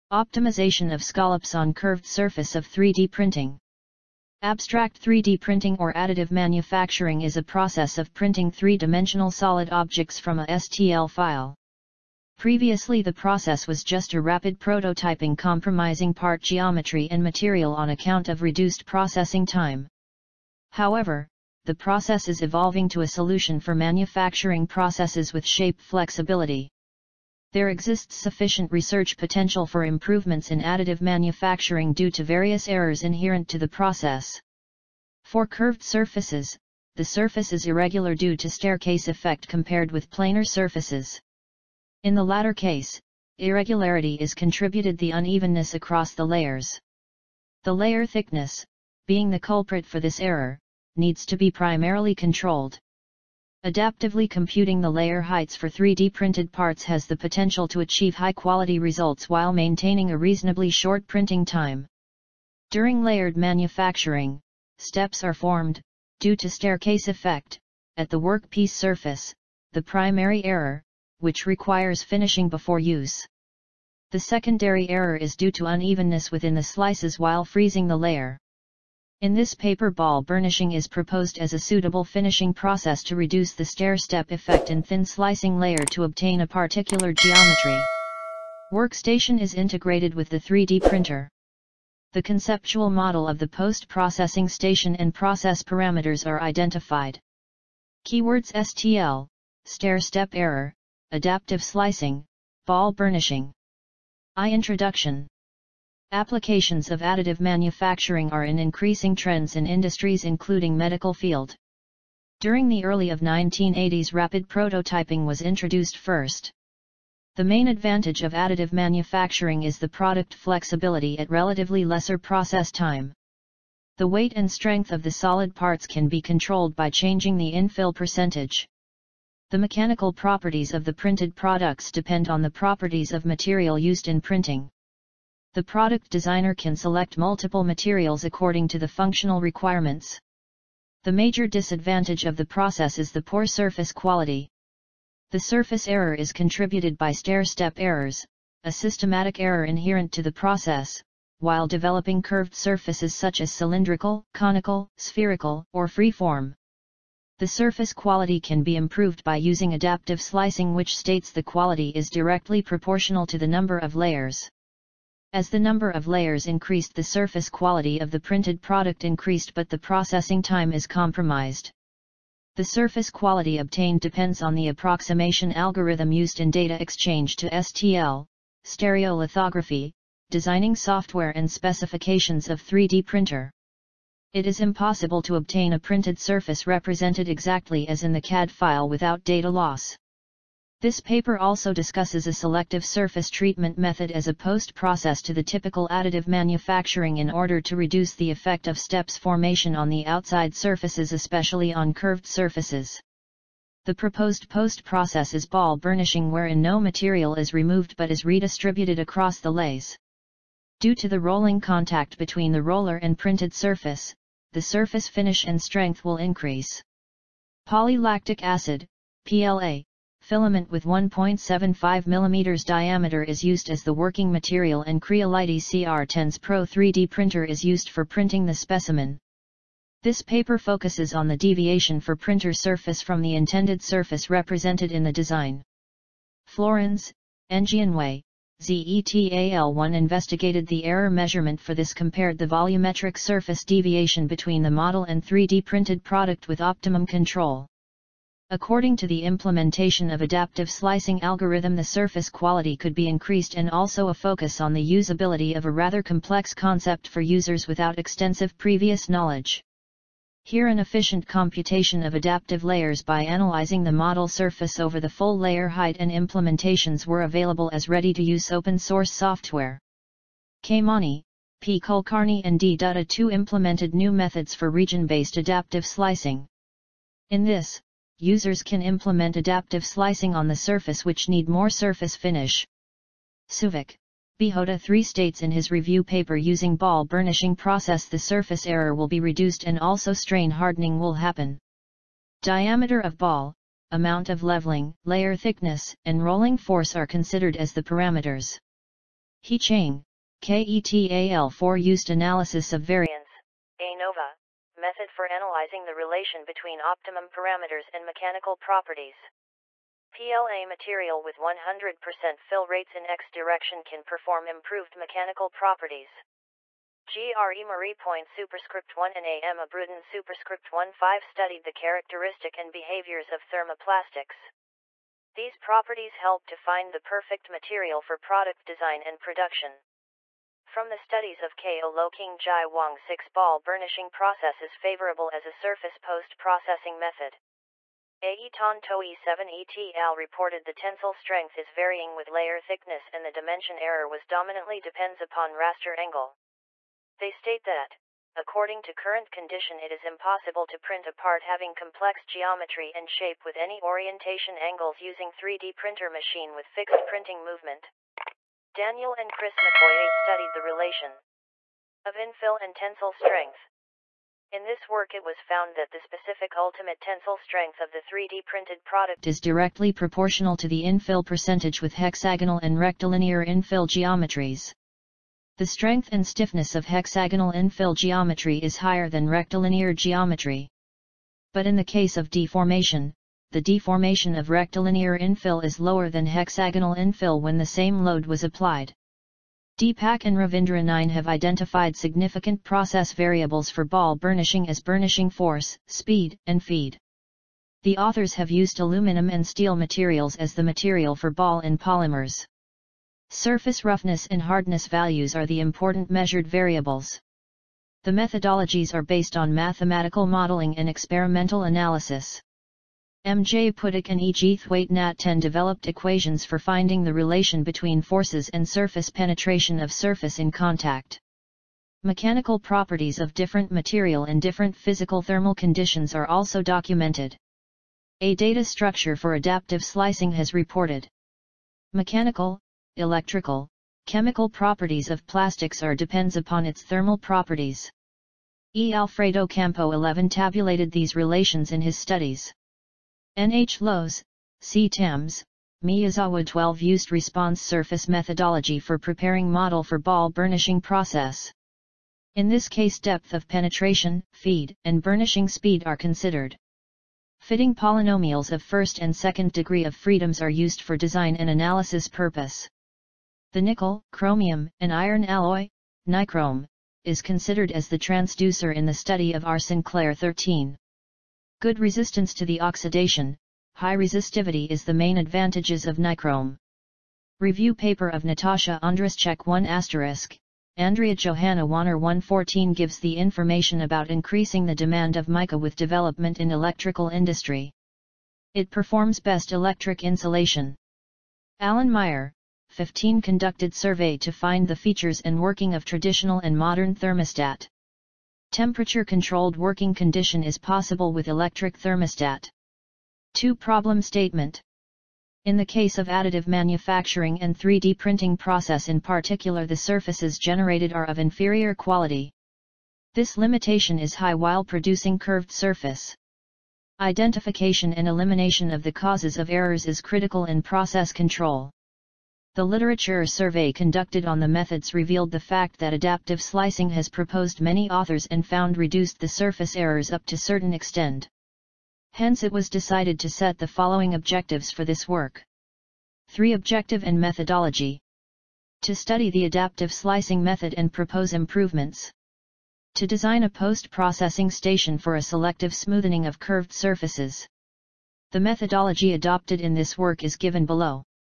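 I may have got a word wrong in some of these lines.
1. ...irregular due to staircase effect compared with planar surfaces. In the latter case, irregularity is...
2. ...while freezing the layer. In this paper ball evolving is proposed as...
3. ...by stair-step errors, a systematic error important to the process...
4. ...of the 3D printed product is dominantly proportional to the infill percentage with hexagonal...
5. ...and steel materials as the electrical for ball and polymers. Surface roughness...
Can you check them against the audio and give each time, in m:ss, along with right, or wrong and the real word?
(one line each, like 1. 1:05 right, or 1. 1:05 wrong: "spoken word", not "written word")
1. 0:37 right
2. 1:17 wrong: "burnishing", not "evolving"
3. 2:26 wrong: "inherent", not "important"
4. 6:07 wrong: "directly", not "dominantly"
5. 6:39 wrong: "material", not "electrical".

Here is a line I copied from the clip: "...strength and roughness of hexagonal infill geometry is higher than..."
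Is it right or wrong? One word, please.
wrong.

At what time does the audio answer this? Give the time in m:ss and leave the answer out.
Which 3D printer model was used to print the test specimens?
3:45.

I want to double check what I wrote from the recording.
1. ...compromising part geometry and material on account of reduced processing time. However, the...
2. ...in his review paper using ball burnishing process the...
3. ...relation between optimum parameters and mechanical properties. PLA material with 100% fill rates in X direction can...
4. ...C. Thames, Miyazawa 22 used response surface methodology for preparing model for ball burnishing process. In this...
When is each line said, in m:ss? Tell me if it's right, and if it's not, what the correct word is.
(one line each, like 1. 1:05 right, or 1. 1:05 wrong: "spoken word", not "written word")
1. 0:15 right
2. 4:45 right
3. 5:05 right
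4. 7:24 wrong: "12", not "22".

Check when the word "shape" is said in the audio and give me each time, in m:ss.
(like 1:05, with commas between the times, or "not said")
0:25, 5:53.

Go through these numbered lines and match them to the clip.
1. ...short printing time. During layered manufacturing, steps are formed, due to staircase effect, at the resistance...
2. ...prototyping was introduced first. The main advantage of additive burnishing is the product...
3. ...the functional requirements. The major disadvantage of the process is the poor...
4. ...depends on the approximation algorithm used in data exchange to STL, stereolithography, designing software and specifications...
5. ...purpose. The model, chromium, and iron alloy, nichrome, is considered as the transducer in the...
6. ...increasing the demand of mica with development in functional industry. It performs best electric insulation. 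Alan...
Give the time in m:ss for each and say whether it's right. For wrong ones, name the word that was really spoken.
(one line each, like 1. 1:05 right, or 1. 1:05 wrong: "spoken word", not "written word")
1. 1:00 wrong: "workpiece", not "resistance"
2. 1:54 wrong: "manufacturing", not "burnishing"
3. 2:18 right
4. 2:53 right
5. 7:42 wrong: "nickel", not "model"
6. 8:04 wrong: "electrical", not "functional".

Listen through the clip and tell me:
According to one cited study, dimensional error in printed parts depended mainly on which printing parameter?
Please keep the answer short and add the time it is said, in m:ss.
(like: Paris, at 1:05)
raster angle, at 5:45.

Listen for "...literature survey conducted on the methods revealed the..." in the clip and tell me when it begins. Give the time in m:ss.
8:42.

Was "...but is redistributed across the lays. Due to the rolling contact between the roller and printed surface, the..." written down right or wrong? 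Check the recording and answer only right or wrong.
right.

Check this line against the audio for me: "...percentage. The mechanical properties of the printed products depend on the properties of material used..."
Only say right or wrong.
right.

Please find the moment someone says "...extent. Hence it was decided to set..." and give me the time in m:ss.
8:50.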